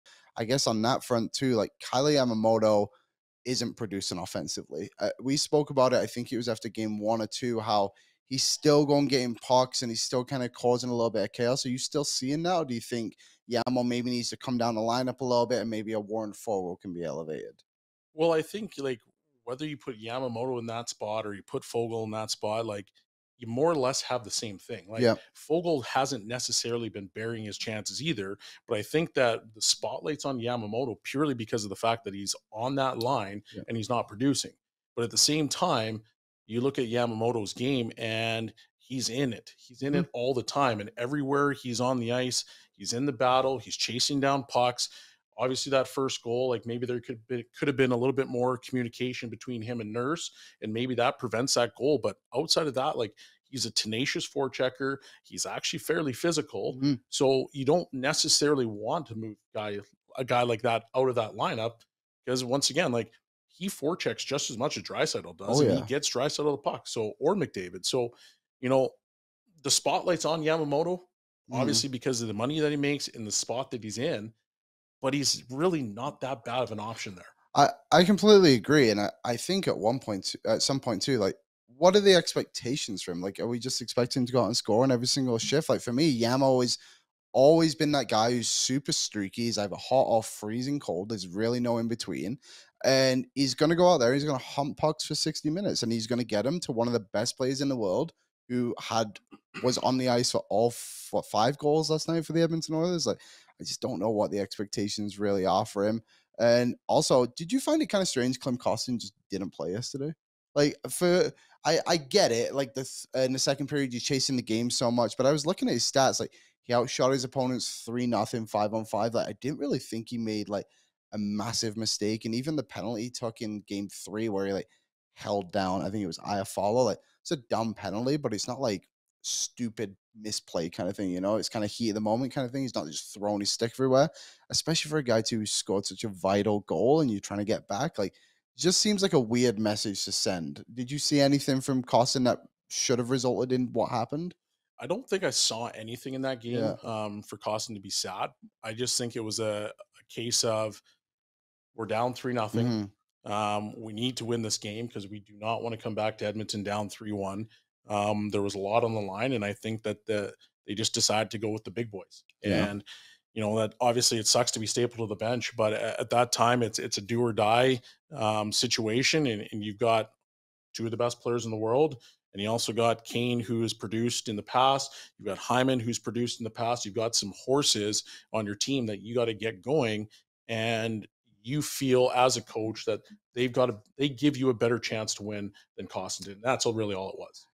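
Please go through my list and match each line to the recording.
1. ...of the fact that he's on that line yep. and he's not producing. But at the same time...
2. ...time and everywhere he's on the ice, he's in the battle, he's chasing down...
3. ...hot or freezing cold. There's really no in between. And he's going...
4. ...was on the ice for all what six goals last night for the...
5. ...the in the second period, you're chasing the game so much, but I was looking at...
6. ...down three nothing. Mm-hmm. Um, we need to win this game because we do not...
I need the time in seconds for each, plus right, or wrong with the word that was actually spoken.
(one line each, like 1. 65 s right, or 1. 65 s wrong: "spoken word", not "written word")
1. 31 s right
2. 40 s right
3. 89 s right
4. 99 s wrong: "five", not "six"
5. 112 s right
6. 151 s right.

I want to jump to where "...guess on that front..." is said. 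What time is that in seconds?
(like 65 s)
0 s.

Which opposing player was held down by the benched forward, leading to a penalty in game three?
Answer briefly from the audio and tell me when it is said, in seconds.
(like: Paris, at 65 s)
Iafallo, at 126 s.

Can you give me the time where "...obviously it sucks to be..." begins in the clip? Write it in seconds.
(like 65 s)
163 s.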